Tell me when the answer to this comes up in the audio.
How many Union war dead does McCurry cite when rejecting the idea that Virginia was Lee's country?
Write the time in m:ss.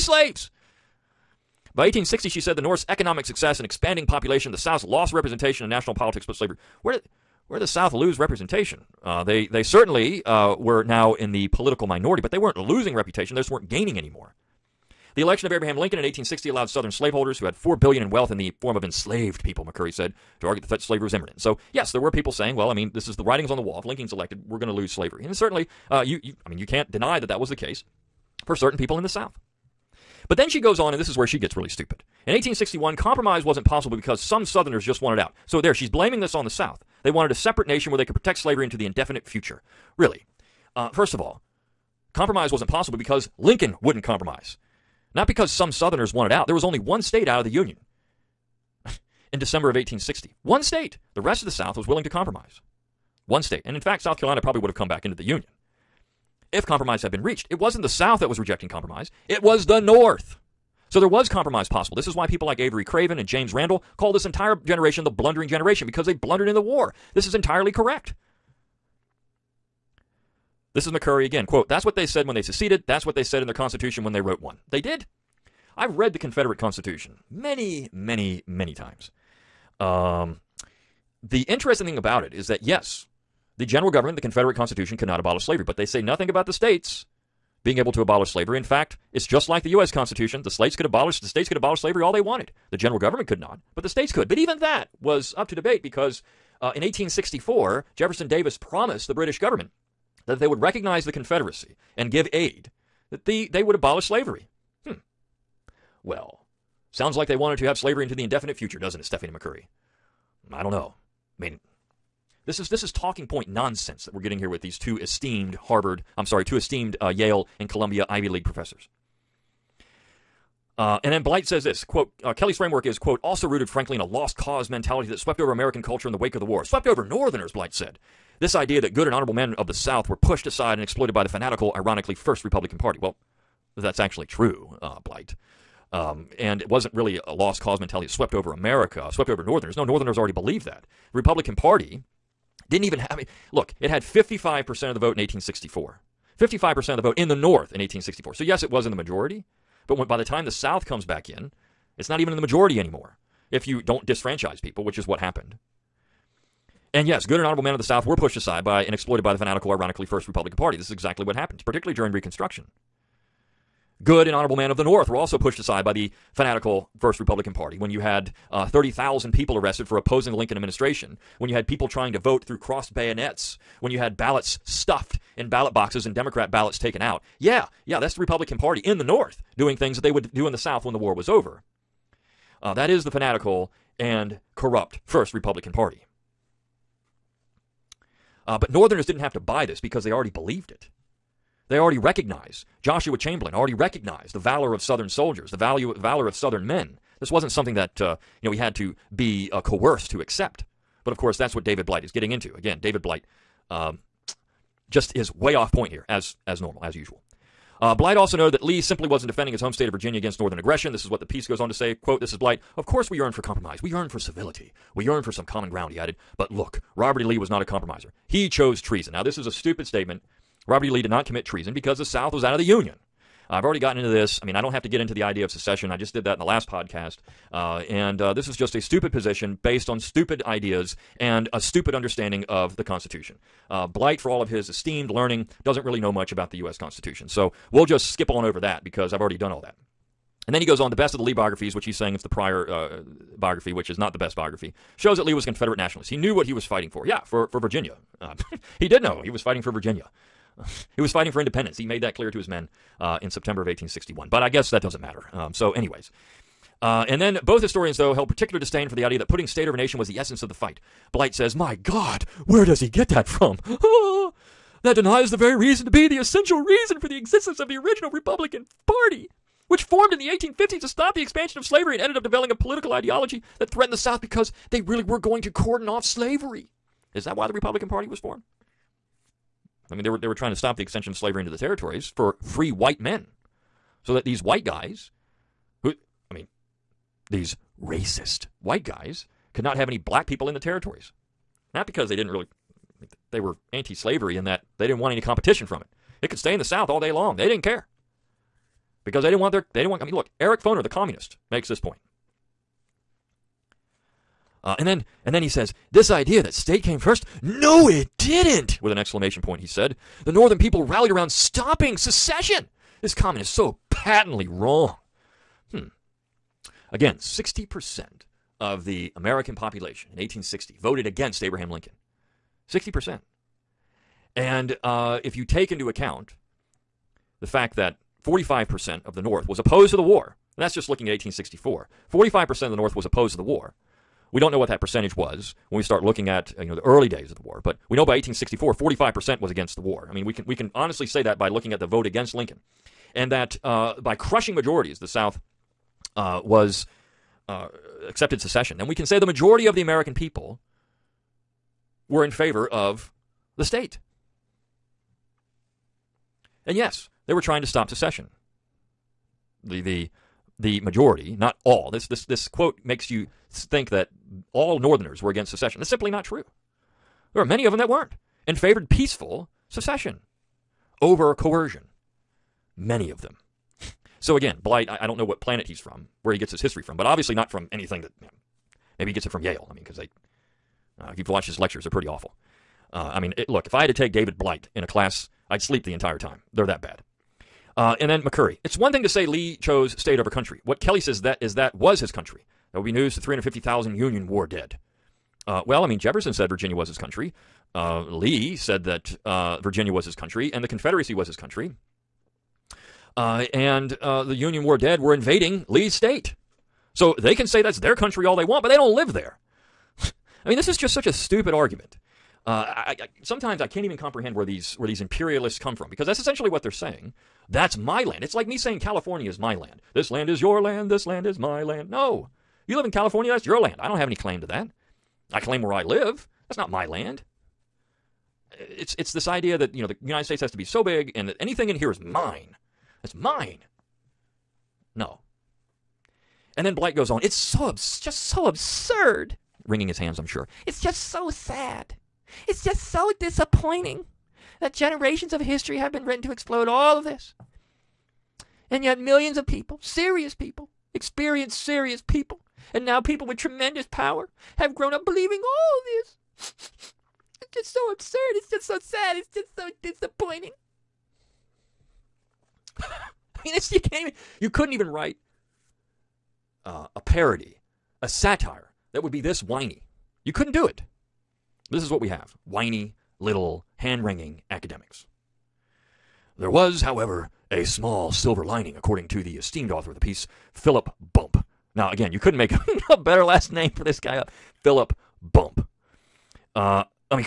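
6:33.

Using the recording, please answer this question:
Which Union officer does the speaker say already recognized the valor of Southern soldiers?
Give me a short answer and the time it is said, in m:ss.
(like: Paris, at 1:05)
Joshua Chamberlain, at 3:12.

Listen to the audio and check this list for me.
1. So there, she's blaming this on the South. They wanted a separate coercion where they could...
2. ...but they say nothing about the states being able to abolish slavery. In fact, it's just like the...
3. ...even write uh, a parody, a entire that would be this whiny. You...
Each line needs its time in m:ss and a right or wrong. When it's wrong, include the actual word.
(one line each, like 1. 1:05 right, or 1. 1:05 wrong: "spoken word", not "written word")
1. 0:35 wrong: "nation", not "coercion"
2. 1:25 right
3. 7:44 wrong: "satire", not "entire".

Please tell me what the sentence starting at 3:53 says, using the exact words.
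Uh, Blight, for all of his esteemed learning, doesn't really know much about the U.S.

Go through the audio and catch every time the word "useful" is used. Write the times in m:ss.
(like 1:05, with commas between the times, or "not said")
not said.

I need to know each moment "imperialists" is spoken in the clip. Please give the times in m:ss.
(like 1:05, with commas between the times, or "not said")
6:55.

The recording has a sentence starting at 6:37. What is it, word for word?
Uh, Lee said that uh, Virginia was his country, and the Confederacy was his country.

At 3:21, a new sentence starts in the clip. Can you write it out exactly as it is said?
But of course, that's what David Blight is getting into.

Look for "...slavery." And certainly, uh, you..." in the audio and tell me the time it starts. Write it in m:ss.
0:24.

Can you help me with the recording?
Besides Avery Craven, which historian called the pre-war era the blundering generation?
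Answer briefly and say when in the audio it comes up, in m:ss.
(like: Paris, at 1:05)
James Randall, at 1:03.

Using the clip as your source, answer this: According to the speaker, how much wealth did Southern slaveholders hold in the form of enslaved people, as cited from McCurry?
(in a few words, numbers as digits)
4 billion.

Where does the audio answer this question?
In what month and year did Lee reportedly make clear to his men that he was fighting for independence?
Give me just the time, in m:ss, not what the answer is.
4:13.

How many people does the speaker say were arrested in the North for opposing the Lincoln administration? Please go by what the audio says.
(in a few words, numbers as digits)
30,000.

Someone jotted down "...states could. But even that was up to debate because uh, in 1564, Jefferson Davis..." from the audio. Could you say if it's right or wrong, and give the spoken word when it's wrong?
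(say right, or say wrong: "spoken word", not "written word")
wrong: "1864", not "1564".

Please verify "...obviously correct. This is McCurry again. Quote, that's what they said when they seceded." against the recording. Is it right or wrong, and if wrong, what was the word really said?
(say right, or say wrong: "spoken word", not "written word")
wrong: "entirely", not "obviously".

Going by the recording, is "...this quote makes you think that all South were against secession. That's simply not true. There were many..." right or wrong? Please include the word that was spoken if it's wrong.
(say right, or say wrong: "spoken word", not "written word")
wrong: "Northerners", not "South".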